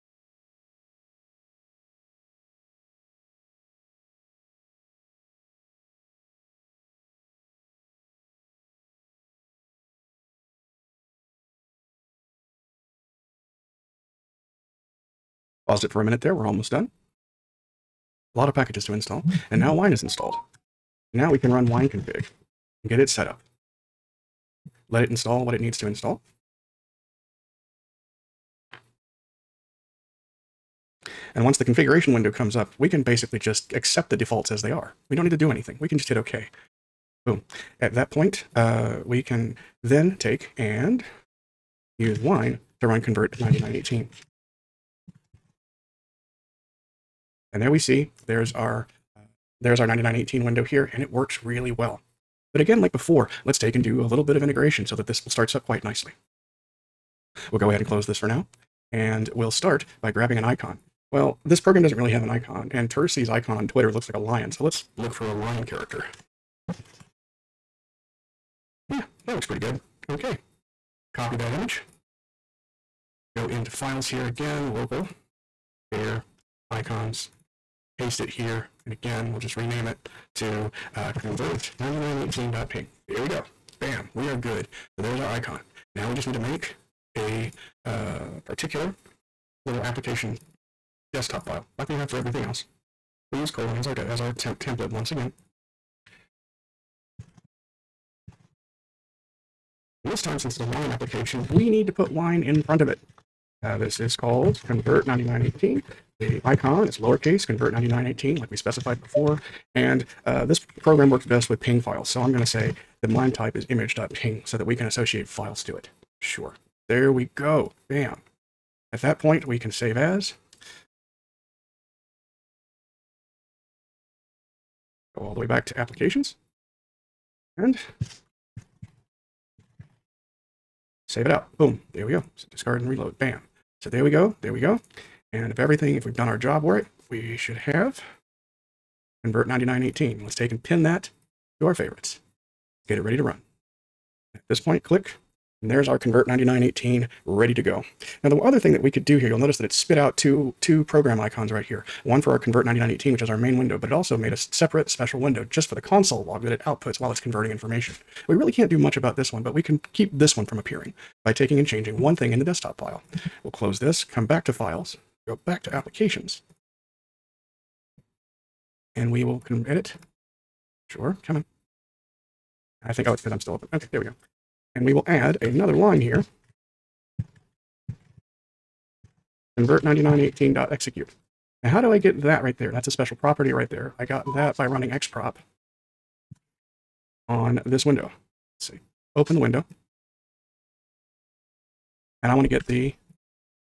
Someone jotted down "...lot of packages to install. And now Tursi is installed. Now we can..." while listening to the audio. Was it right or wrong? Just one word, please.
wrong.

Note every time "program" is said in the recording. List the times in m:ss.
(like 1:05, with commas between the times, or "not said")
1:01, 1:50, 2:30.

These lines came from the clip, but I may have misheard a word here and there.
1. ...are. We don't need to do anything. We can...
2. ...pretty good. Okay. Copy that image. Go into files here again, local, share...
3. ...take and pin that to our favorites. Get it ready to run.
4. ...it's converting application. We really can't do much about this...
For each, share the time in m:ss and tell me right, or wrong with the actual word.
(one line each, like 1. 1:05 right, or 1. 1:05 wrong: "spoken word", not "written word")
1. 0:34 right
2. 1:09 right
3. 2:20 right
4. 2:37 wrong: "information", not "application".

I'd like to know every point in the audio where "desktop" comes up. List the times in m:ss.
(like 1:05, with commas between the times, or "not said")
1:31, 2:42.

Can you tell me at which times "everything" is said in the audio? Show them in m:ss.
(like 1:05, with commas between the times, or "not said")
1:32, 2:15.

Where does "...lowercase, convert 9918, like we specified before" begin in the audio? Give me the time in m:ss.
1:46.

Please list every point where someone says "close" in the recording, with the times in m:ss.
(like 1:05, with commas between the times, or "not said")
0:57, 2:43.